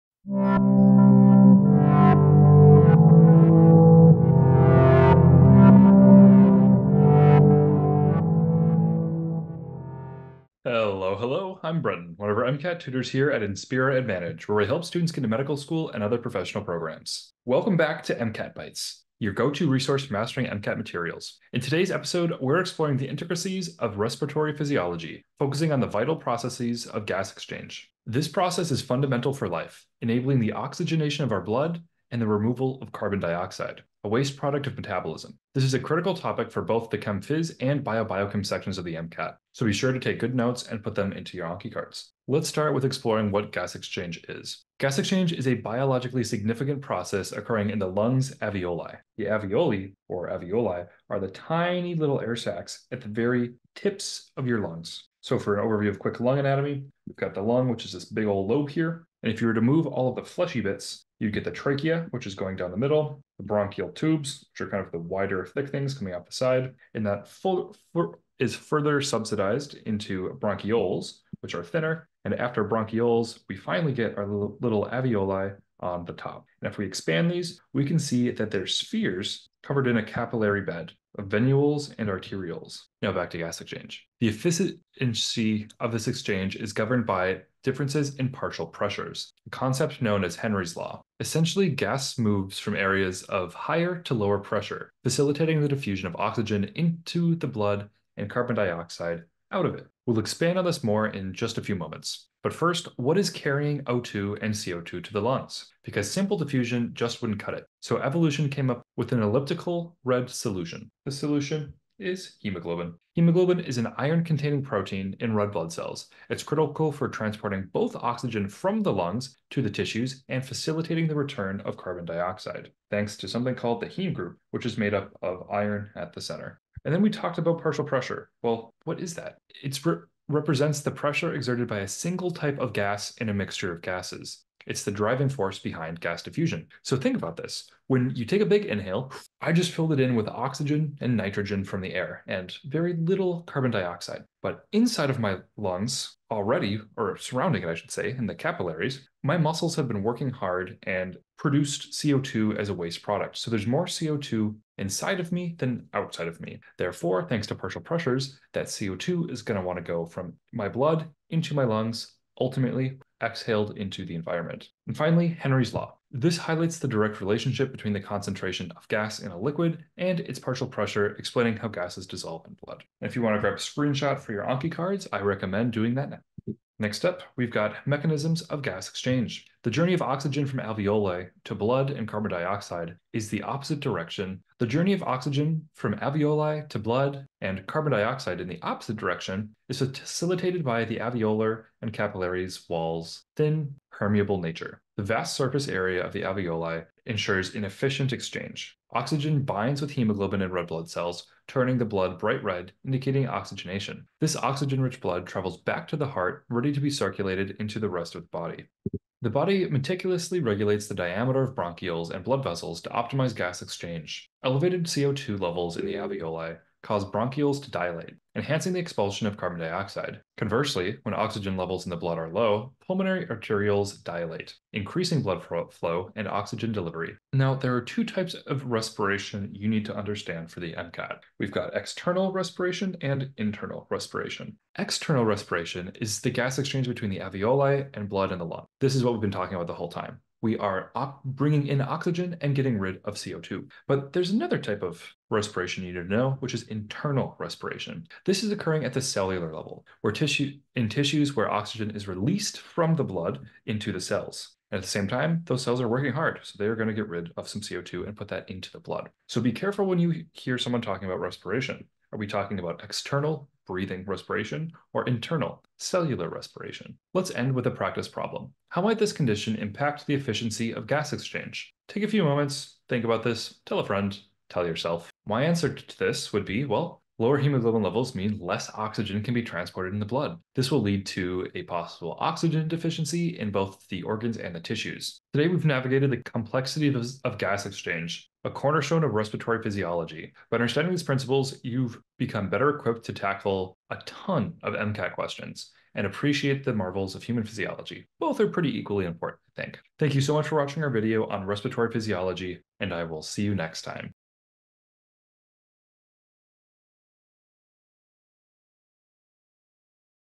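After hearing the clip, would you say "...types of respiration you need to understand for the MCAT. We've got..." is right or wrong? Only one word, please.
right.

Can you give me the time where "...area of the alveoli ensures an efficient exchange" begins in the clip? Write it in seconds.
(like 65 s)
195 s.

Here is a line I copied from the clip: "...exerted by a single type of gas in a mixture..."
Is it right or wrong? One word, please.
right.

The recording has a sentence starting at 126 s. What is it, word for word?
And then we talked about partial pressure.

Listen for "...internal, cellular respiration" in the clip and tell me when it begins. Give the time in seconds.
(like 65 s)
265 s.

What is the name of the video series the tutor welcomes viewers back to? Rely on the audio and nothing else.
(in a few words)
MCAT Bites.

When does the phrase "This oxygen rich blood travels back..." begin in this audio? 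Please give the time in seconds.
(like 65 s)
204 s.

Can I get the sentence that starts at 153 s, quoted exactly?
So there's more CO2 inside of me than outside of me.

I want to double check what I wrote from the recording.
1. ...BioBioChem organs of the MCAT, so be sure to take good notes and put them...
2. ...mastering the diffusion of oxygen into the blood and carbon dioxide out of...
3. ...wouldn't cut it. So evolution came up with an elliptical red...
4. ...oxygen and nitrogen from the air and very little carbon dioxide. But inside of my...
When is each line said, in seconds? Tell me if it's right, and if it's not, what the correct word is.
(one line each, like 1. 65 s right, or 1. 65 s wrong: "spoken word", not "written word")
1. 37 s wrong: "sections", not "organs"
2. 95 s wrong: "facilitating", not "mastering"
3. 107 s right
4. 140 s right.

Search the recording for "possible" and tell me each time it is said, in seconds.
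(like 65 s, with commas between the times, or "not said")
281 s.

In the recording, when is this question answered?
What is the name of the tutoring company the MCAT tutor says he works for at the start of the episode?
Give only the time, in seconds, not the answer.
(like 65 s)
13 s.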